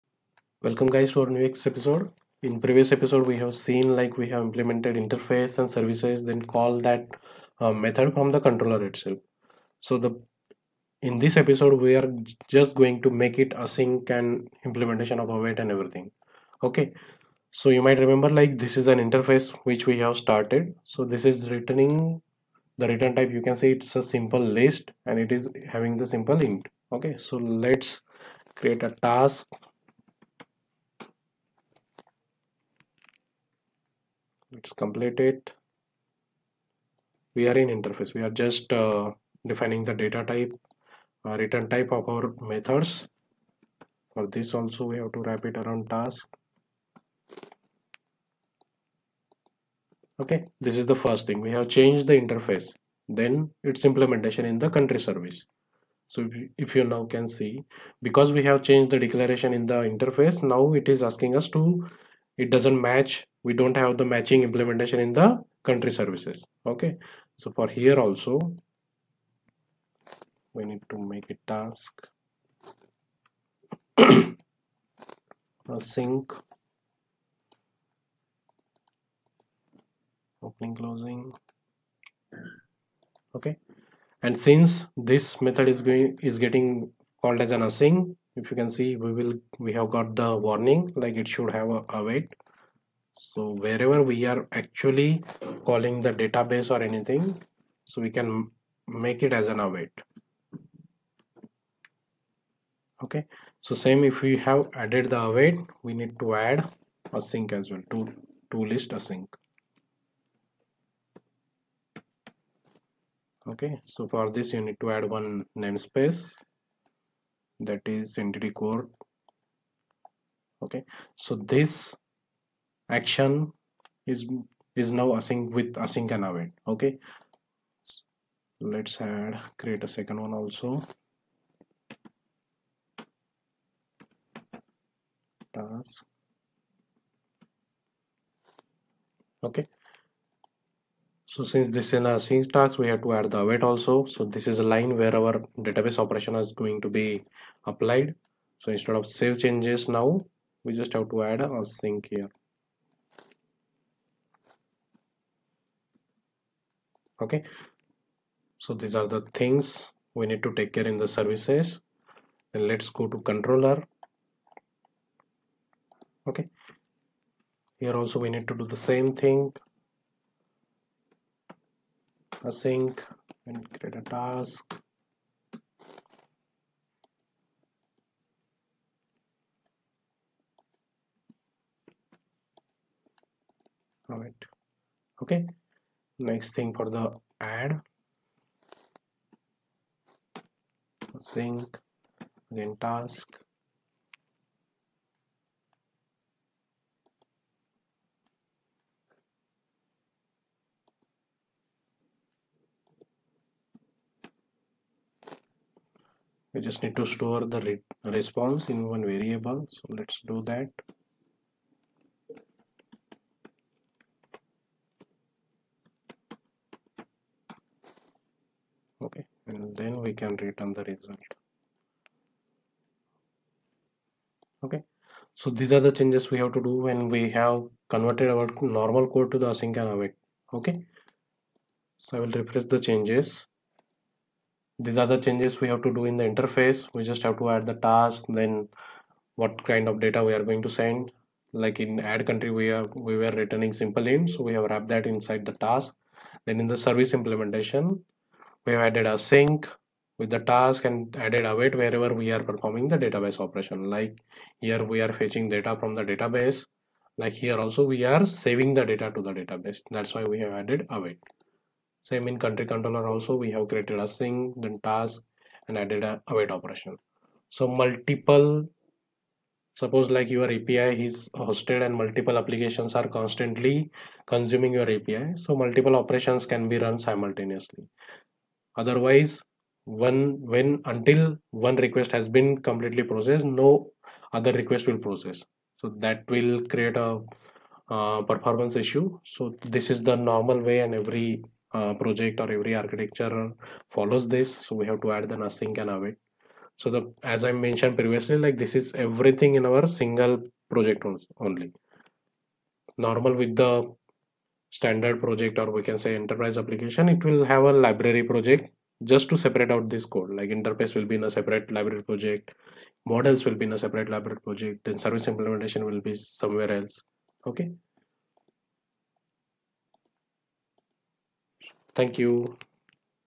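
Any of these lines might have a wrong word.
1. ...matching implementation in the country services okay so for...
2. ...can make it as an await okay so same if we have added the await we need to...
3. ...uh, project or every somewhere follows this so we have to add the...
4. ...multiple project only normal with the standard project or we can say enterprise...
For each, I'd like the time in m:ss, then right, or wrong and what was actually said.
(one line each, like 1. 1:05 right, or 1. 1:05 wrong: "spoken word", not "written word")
1. 1:04 right
2. 1:38 right
3. 4:51 wrong: "architecture", not "somewhere"
4. 4:59 wrong: "single", not "multiple".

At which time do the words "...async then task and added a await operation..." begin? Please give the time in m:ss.
4:24.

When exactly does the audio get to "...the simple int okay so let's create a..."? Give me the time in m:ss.
0:25.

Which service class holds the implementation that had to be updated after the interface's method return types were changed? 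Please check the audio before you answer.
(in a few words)
country service.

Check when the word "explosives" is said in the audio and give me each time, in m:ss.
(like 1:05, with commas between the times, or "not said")
not said.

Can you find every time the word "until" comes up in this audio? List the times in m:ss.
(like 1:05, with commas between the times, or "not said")
4:40.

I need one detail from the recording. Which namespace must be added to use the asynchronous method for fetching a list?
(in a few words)
entity core.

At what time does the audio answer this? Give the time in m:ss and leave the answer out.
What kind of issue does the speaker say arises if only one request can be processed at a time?
4:48.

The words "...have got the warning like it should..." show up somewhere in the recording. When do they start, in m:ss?
1:29.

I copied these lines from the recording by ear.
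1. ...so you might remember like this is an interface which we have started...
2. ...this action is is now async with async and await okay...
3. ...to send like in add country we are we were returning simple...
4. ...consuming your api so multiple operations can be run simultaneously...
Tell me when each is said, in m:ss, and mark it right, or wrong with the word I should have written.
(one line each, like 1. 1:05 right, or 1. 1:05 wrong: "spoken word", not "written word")
1. 0:17 right
2. 2:01 right
3. 4:00 right
4. 4:34 right.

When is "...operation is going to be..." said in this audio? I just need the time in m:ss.
2:25.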